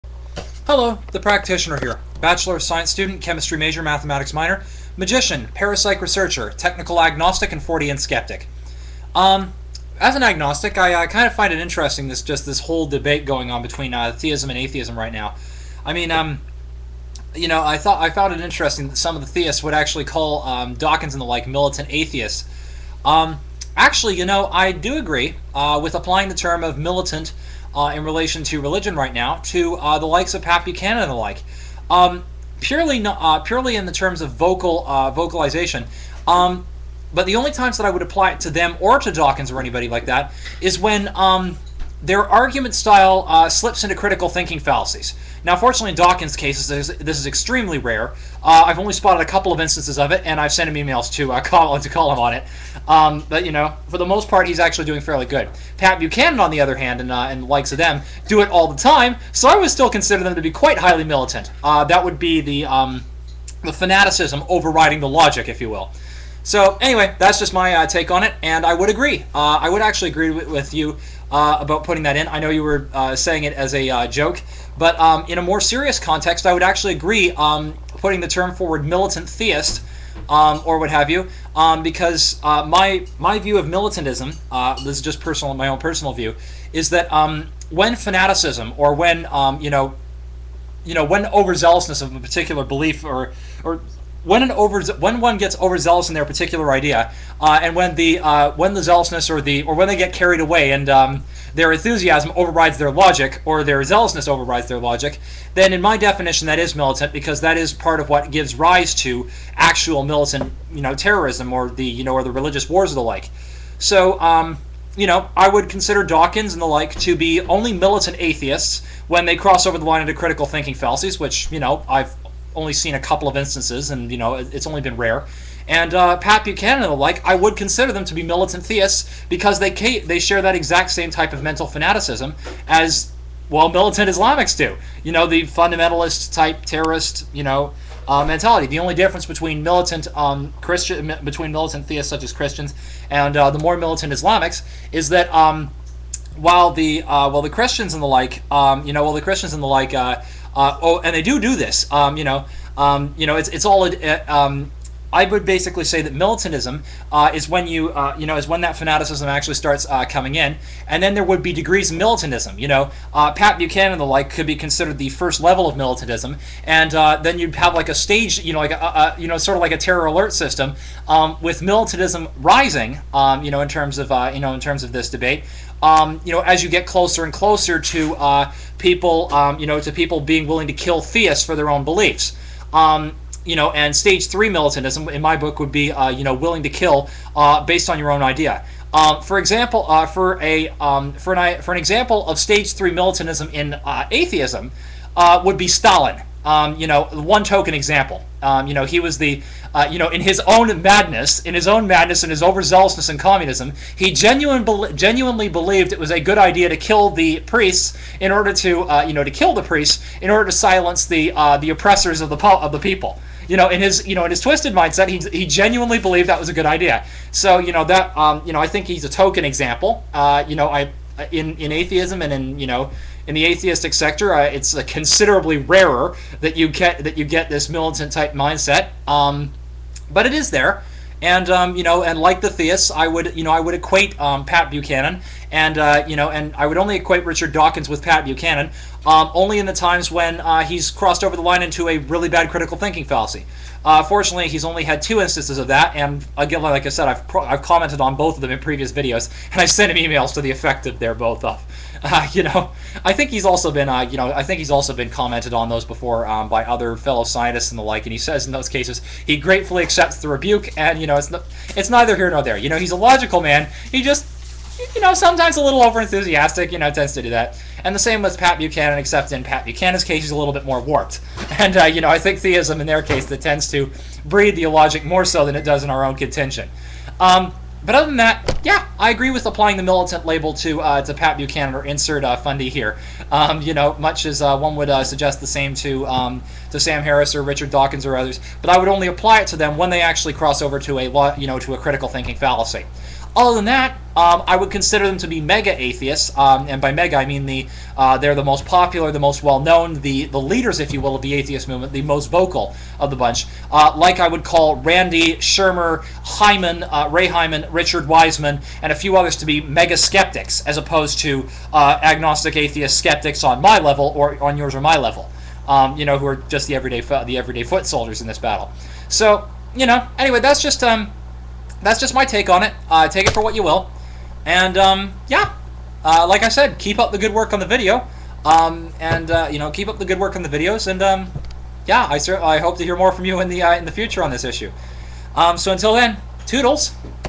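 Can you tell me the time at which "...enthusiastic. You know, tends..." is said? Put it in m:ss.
4:26.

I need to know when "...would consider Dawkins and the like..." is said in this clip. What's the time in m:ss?
1:55.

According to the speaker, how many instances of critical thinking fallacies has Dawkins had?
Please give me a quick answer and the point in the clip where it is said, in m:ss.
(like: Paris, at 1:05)
2, at 4:05.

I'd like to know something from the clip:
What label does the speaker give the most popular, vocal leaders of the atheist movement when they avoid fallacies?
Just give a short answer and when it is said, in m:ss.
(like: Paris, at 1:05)
Mega atheists, at 4:55.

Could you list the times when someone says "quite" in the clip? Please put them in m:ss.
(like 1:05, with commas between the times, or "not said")
1:00.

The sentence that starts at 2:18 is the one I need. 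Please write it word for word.
The only difference between militant um, Christian between militant theists such as Christians and uh, the more militant Islamics is that.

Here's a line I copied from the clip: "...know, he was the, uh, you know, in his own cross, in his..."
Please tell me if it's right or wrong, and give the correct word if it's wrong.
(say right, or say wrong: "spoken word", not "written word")
wrong: "madness", not "cross".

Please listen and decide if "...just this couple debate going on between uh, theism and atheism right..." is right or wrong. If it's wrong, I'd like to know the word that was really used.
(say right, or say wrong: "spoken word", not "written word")
wrong: "whole", not "couple".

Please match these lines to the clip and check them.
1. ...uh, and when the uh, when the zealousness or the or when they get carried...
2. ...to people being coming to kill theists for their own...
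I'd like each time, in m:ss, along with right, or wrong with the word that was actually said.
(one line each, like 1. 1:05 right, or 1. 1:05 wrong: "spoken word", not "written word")
1. 1:37 right
2. 2:59 wrong: "willing", not "coming".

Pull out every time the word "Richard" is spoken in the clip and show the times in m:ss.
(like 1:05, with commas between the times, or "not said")
3:57, 4:47, 5:07.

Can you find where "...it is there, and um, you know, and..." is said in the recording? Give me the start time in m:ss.
3:50.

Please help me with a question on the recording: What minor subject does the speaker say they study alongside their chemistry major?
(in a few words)
Mathematics.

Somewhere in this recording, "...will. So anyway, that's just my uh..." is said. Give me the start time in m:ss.
1:05.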